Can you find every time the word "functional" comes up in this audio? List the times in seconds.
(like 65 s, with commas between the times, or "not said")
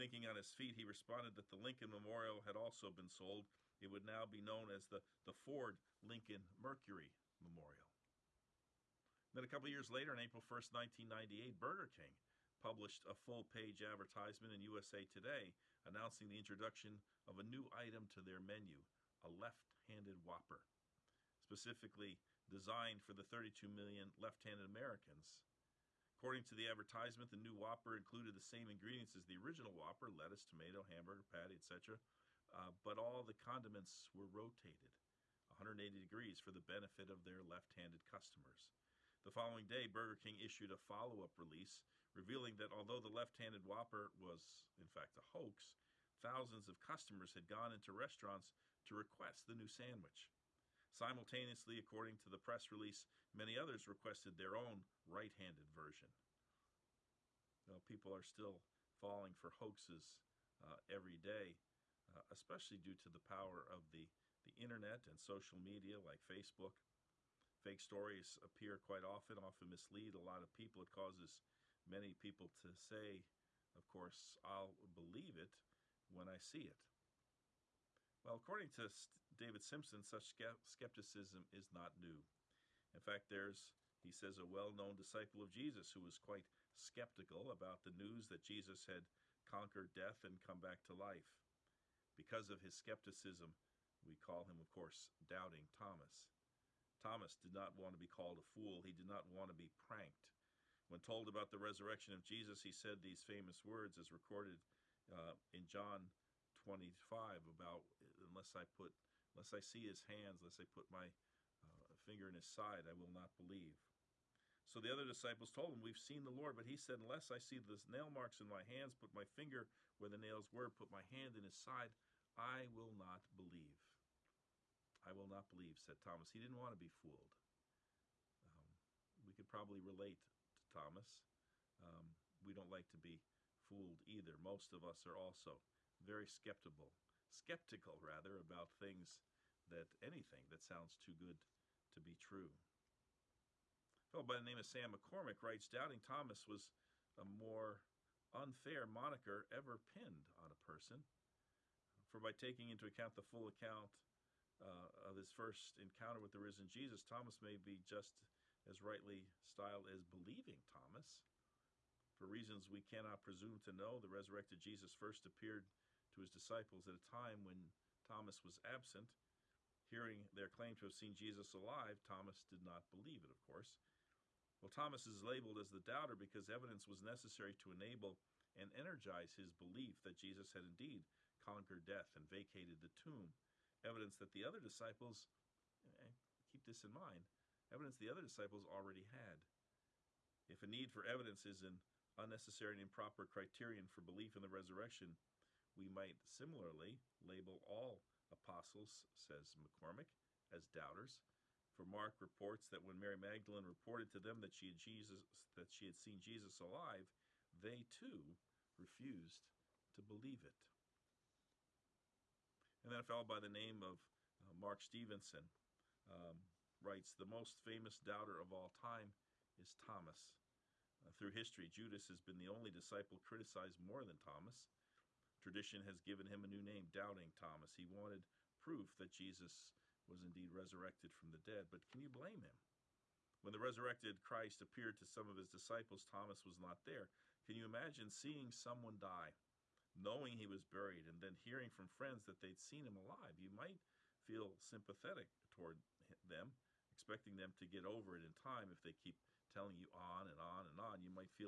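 not said.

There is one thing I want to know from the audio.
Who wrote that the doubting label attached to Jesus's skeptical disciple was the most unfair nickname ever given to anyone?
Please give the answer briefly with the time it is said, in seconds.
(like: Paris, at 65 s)
Sam McCormick, at 144 s.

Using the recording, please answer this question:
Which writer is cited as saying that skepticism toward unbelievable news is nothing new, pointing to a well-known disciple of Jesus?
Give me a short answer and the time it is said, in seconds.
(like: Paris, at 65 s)
David Simpson, at 79 s.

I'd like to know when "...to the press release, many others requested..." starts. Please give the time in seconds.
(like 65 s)
52 s.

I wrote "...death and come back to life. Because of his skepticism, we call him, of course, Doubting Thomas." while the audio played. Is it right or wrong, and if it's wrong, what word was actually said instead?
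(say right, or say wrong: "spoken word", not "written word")
right.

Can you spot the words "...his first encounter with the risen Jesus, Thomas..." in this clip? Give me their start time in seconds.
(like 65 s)
155 s.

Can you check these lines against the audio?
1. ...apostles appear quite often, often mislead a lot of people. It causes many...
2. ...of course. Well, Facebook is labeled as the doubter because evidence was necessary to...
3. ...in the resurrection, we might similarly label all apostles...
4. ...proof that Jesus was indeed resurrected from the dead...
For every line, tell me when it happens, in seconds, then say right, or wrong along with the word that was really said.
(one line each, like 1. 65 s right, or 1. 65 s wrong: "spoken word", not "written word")
1. 67 s wrong: "stories", not "apostles"
2. 173 s wrong: "Thomas", not "Facebook"
3. 194 s right
4. 228 s right.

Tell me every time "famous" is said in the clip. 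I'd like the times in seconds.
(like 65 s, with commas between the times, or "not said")
103 s, 217 s.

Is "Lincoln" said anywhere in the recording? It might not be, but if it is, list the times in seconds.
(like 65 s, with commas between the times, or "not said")
1 s, 6 s.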